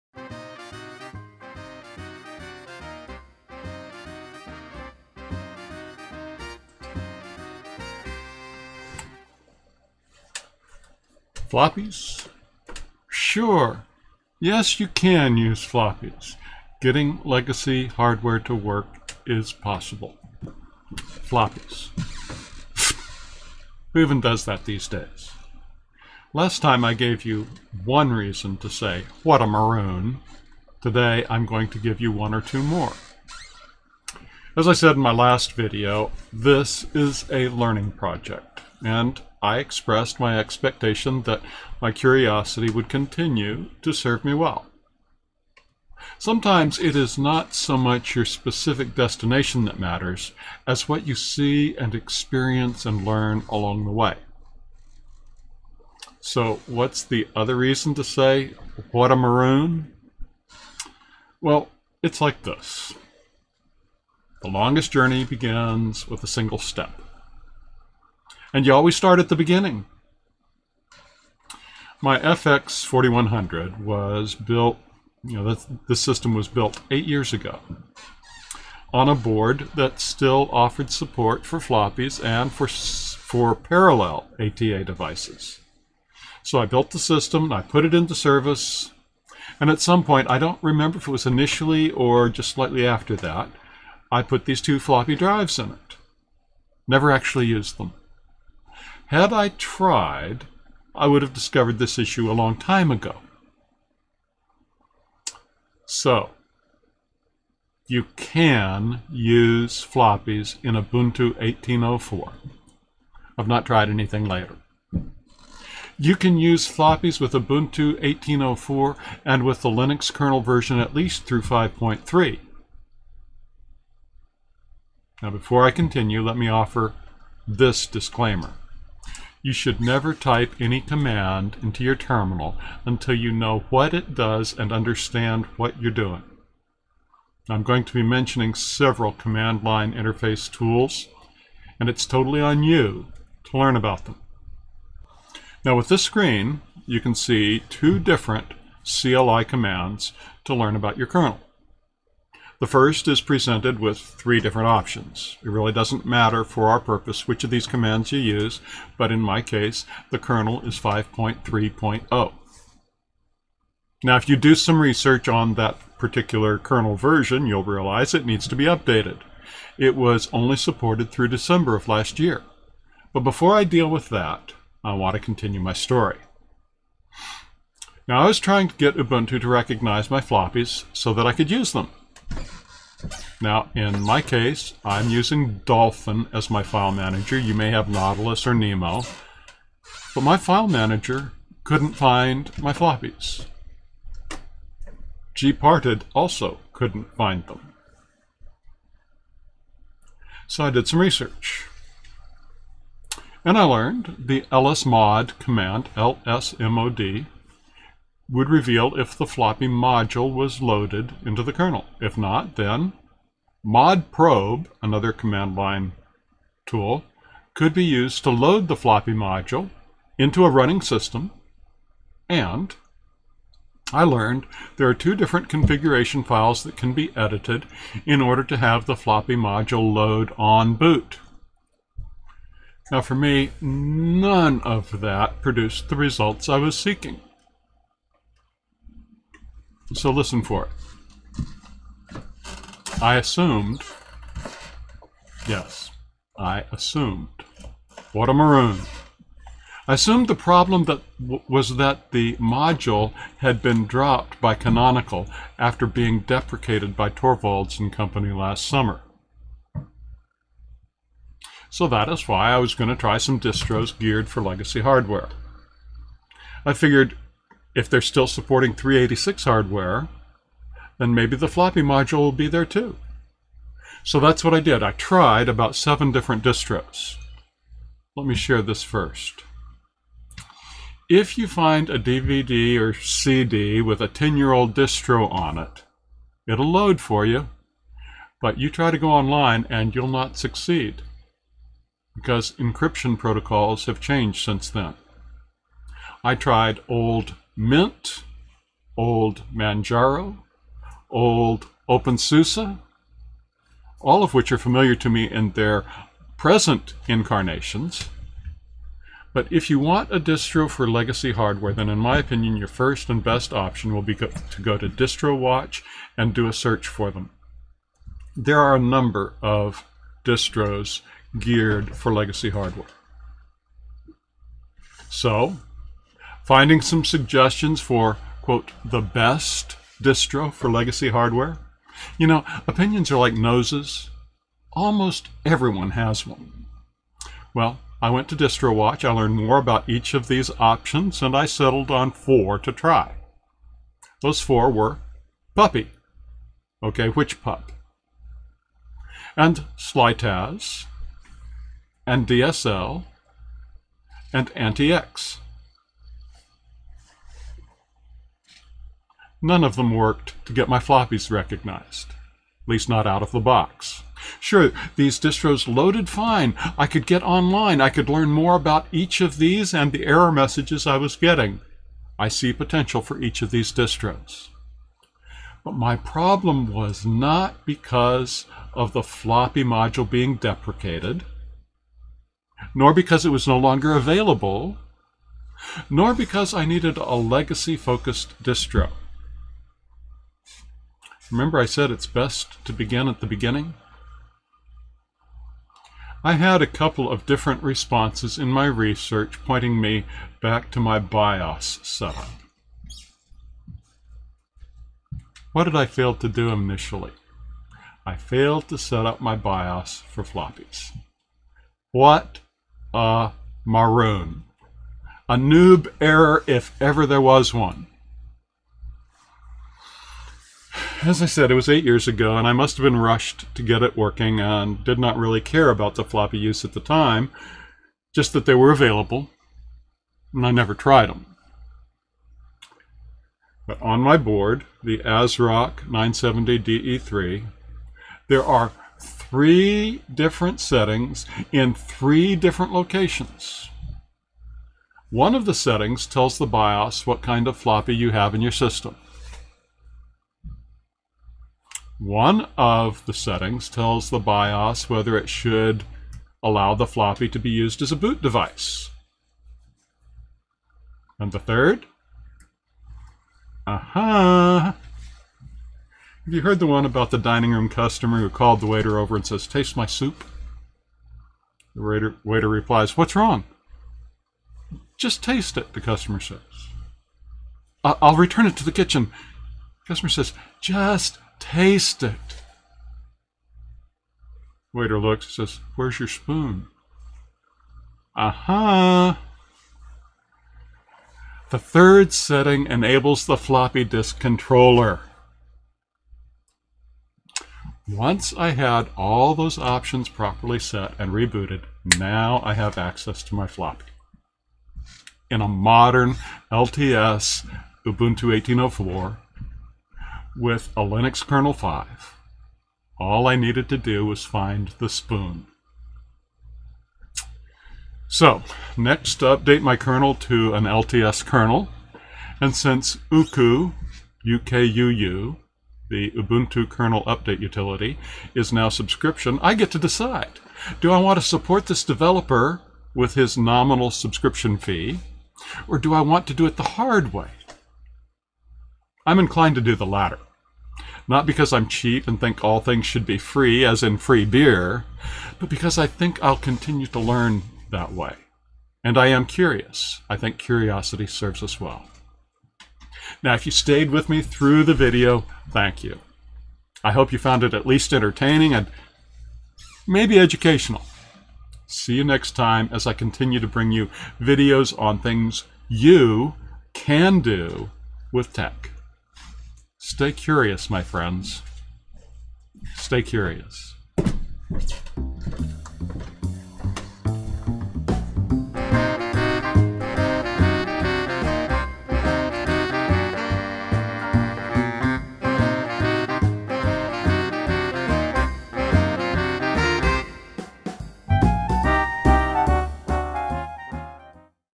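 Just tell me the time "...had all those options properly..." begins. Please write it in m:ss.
8:18.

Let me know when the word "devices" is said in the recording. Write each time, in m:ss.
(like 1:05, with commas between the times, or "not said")
1:24, 7:38.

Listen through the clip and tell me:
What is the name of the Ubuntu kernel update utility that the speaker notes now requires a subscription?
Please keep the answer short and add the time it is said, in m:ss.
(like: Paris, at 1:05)
UKUU, at 8:44.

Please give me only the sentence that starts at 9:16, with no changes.
I hope you found it at least entertaining and maybe educational.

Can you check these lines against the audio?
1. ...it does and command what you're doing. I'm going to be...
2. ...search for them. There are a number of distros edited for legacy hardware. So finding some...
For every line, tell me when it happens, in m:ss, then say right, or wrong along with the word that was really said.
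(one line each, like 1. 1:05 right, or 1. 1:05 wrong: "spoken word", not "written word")
1. 2:13 wrong: "understand", not "command"
2. 5:16 wrong: "geared", not "edited".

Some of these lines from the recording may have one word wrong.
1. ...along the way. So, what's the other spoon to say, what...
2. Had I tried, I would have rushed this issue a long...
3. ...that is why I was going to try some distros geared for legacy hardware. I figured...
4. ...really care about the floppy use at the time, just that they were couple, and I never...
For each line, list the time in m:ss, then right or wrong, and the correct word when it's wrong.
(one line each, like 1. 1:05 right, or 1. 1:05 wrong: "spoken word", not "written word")
1. 0:53 wrong: "reason", not "spoon"
2. 1:39 wrong: "discovered", not "rushed"
3. 4:21 right
4. 7:05 wrong: "available", not "couple".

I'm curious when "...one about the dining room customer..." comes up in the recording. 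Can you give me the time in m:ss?
7:46.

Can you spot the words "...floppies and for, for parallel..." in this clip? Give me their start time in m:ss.
1:21.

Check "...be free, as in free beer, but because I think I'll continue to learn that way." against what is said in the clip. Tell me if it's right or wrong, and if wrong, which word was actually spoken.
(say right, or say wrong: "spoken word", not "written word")
right.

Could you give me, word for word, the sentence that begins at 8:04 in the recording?
Waiter looks says, Where's your spoon?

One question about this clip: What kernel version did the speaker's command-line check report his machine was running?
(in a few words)
5.3.0.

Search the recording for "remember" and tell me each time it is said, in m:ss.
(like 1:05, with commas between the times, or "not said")
1:30, 6:31.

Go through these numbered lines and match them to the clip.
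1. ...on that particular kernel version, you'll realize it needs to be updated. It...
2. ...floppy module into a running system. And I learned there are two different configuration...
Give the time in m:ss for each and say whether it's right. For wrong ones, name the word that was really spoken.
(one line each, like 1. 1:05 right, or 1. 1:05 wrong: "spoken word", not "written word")
1. 2:45 right
2. 3:38 right.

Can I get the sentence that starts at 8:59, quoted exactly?
I'm inclined to do the latter.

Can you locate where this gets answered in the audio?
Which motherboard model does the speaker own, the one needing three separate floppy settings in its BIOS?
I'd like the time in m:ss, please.
7:14.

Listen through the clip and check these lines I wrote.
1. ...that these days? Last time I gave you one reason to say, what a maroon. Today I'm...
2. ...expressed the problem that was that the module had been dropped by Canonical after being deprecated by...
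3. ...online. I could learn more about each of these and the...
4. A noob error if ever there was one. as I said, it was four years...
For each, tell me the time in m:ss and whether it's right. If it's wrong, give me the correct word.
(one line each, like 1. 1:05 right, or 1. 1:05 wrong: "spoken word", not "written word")
1. 0:24 right
2. 4:09 wrong: "assumed", not "expressed"
3. 6:07 right
4. 6:55 wrong: "eight", not "four".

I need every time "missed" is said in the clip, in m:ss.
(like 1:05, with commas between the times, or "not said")
not said.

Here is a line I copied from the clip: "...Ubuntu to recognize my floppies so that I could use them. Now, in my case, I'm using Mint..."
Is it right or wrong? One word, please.
wrong.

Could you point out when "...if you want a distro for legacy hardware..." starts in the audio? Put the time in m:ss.
5:09.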